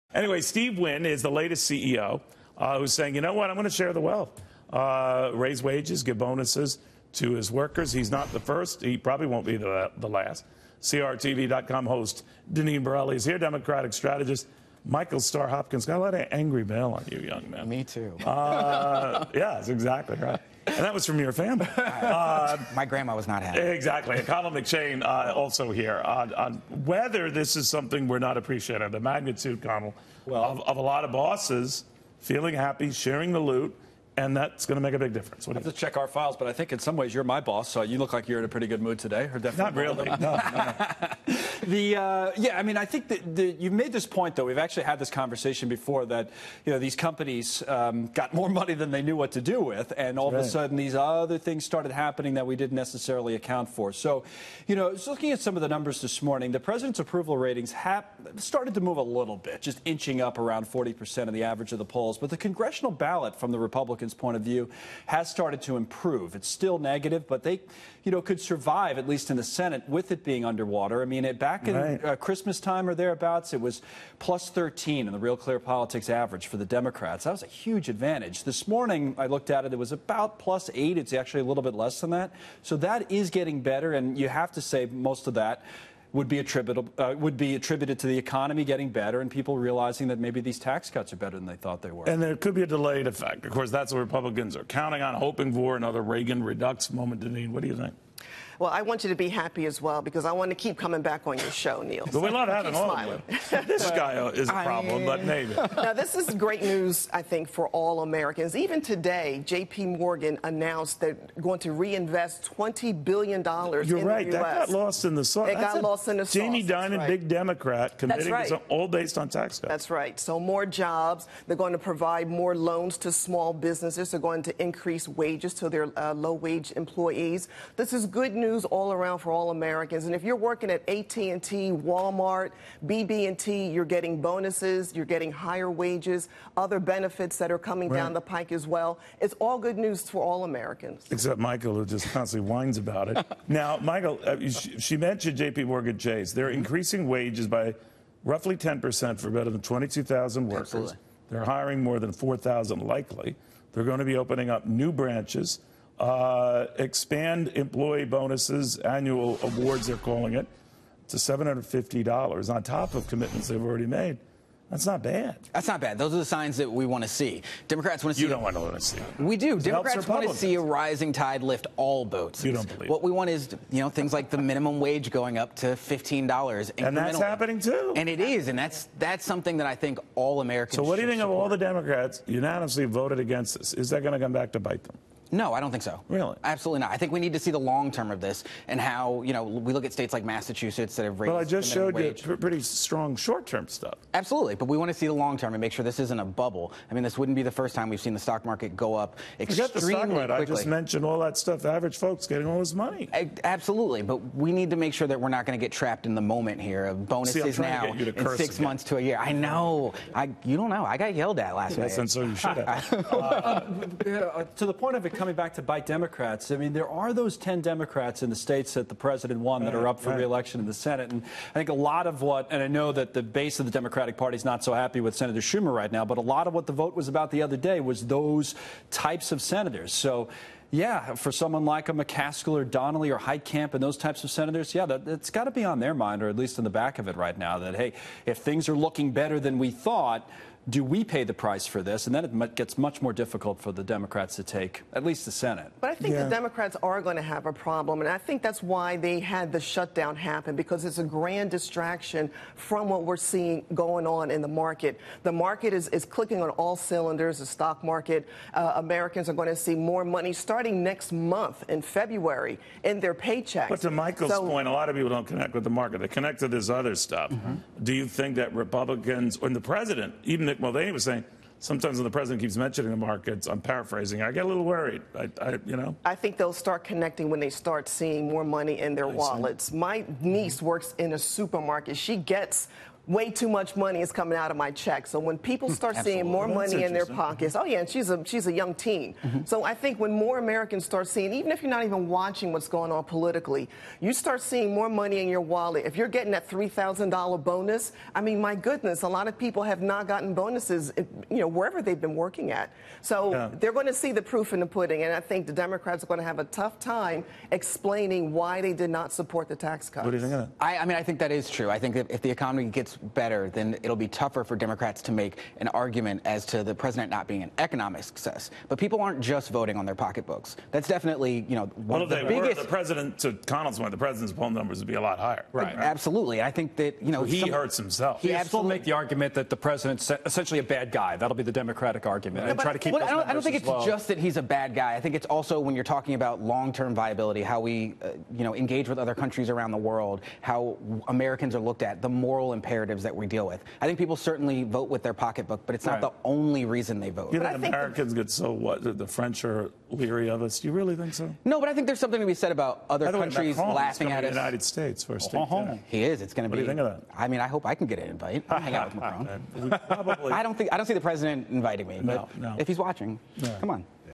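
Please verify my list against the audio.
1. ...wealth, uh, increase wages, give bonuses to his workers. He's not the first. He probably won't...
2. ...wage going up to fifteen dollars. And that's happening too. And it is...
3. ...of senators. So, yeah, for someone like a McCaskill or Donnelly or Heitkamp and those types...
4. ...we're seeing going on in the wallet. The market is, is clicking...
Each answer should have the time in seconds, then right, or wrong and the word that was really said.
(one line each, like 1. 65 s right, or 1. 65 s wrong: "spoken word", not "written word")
1. 4 s wrong: "raise", not "increase"
2. 174 s right
3. 229 s right
4. 253 s wrong: "market", not "wallet".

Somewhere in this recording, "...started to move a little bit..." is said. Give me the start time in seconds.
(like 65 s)
58 s.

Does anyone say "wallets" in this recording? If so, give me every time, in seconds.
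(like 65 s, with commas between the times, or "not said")
279 s, 295 s.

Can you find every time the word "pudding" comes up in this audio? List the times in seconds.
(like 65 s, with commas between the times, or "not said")
304 s.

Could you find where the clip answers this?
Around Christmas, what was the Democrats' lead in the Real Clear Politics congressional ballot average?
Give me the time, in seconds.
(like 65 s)
74 s.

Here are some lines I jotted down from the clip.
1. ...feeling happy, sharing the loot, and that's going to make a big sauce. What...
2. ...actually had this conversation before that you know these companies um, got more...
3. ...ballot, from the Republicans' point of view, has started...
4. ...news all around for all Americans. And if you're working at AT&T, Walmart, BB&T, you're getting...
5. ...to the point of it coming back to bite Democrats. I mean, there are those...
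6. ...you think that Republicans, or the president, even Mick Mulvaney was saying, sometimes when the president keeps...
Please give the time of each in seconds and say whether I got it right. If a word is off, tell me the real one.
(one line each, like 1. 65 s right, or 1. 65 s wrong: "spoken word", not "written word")
1. 32 s wrong: "difference", not "sauce"
2. 44 s right
3. 62 s right
4. 128 s right
5. 214 s right
6. 267 s right.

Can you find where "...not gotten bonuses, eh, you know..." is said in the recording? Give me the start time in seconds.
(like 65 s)
299 s.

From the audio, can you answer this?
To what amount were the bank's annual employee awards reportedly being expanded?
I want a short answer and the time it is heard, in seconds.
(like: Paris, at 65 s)
$750, at 161 s.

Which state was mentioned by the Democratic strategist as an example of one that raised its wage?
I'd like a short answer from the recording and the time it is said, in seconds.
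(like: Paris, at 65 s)
Massachusetts, at 190 s.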